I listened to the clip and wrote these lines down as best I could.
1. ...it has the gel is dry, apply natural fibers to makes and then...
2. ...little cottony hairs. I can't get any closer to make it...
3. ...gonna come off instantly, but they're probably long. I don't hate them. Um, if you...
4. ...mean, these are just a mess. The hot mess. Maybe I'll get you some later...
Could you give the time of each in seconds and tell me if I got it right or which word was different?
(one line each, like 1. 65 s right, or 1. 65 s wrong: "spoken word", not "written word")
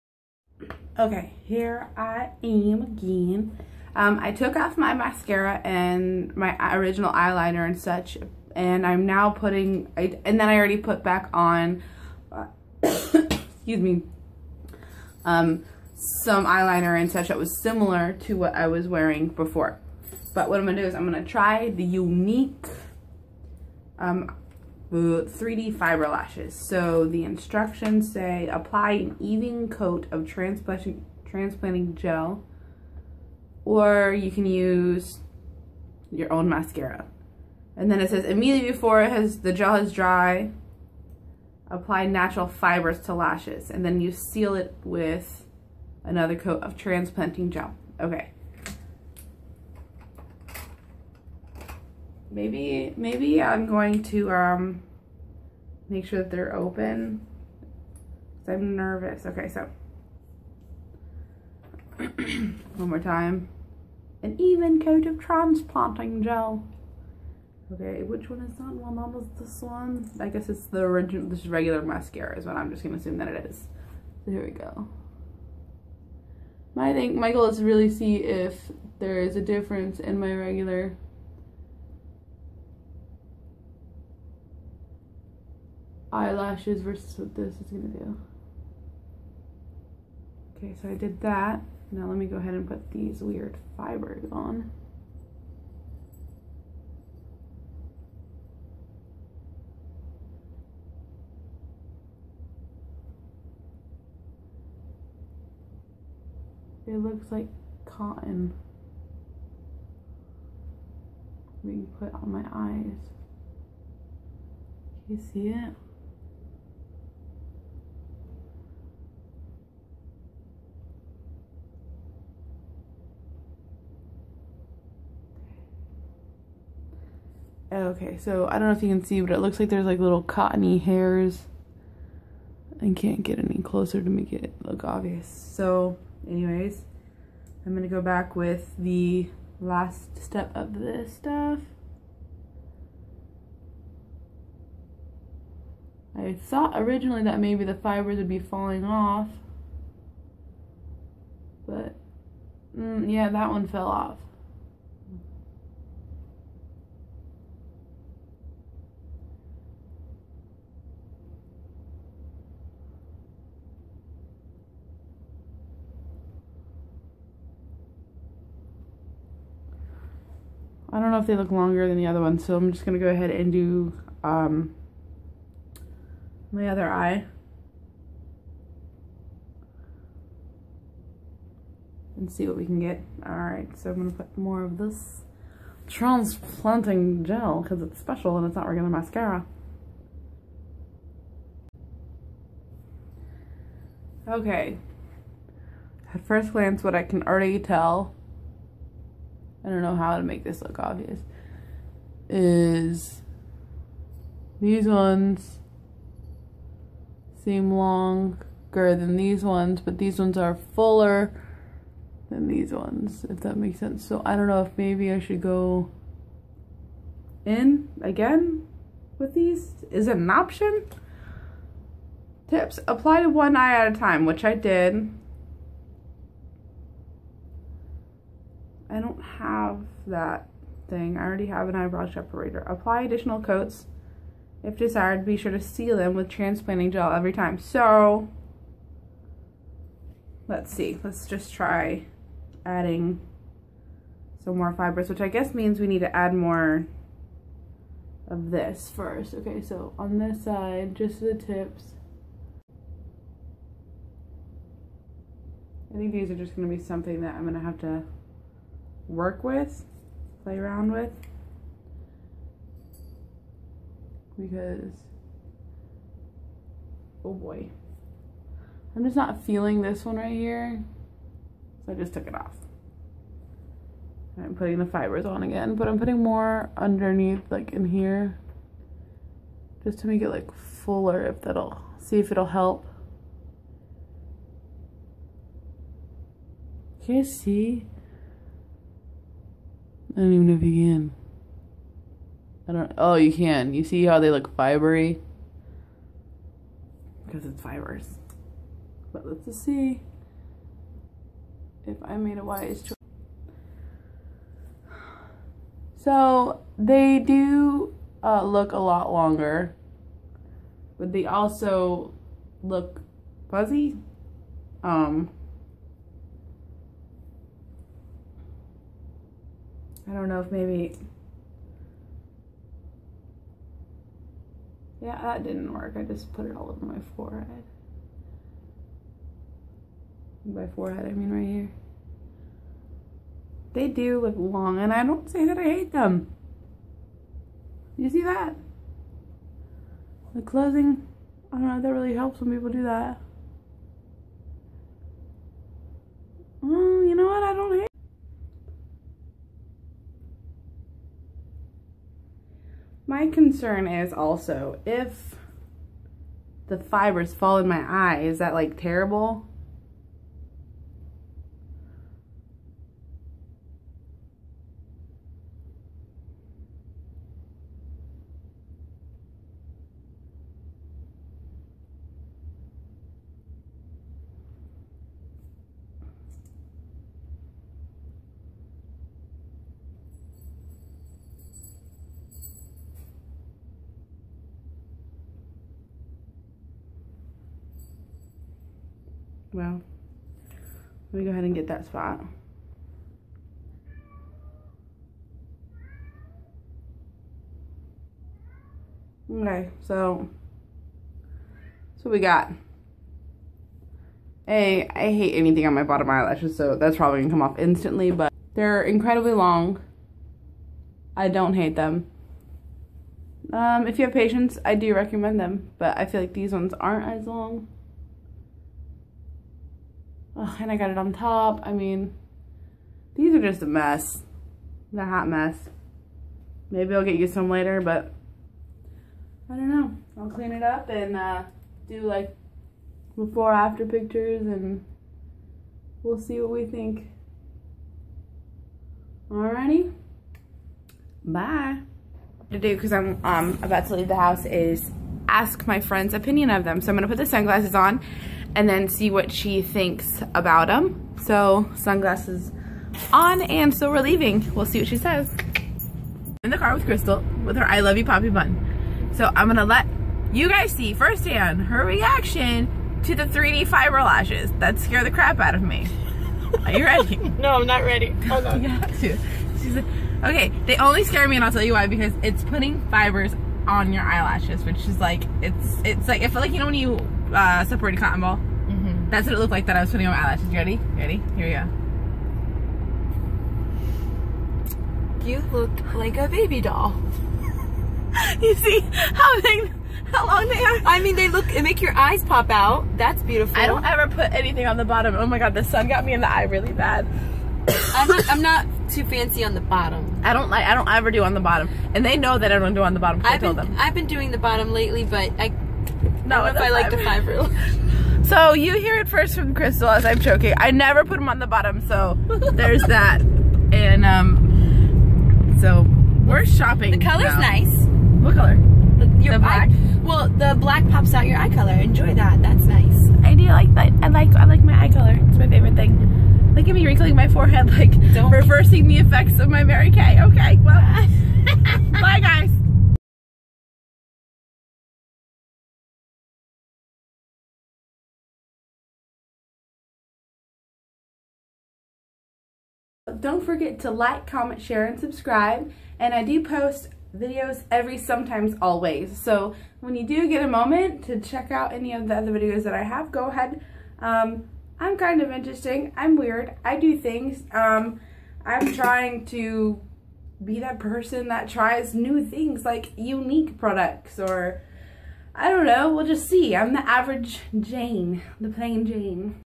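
1. 39 s wrong: "lashes", not "makes"
2. 129 s right
3. 407 s wrong: "incredibly", not "probably"
4. 421 s right.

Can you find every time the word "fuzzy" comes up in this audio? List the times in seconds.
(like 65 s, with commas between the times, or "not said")
313 s.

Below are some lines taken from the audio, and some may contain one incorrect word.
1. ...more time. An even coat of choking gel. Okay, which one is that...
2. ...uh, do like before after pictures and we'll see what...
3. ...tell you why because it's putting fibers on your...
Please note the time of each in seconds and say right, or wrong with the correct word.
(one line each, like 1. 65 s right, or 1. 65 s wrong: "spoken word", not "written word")
1. 62 s wrong: "transplanting", not "choking"
2. 431 s right
3. 471 s right.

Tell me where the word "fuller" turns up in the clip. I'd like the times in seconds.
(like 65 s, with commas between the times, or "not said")
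210 s, 280 s.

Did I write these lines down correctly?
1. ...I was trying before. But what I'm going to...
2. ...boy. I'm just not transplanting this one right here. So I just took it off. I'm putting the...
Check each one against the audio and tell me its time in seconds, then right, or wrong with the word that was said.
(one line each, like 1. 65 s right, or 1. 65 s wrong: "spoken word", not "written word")
1. 18 s wrong: "wearing", not "trying"
2. 267 s wrong: "feeling", not "transplanting".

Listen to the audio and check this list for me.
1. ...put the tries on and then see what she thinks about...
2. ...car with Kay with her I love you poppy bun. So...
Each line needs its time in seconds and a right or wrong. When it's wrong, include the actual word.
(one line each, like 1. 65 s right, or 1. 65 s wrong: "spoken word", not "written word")
1. 447 s wrong: "sunglasses", not "tries"
2. 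456 s wrong: "Crystal", not "Kay".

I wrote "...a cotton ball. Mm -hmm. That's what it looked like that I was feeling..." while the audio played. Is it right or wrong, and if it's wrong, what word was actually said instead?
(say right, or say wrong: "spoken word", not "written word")
wrong: "putting", not "feeling".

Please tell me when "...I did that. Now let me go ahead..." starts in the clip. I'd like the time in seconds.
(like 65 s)
90 s.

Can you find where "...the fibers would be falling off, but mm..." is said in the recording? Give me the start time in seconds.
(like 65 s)
147 s.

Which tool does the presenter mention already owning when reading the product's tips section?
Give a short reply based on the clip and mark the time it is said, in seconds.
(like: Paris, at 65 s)
Eyebrow separator, at 231 s.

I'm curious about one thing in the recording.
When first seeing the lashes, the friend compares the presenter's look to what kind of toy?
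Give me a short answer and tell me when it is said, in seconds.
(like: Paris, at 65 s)
A baby doll, at 486 s.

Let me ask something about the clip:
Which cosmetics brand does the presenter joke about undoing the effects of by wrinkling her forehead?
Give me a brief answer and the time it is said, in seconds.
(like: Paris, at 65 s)
Mary Kay, at 529 s.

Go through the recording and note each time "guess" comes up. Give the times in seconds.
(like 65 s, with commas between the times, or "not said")
70 s, 245 s.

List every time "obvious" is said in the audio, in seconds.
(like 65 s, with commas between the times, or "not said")
134 s, 200 s.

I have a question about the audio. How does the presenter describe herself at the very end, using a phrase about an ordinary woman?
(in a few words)
Plain Jane.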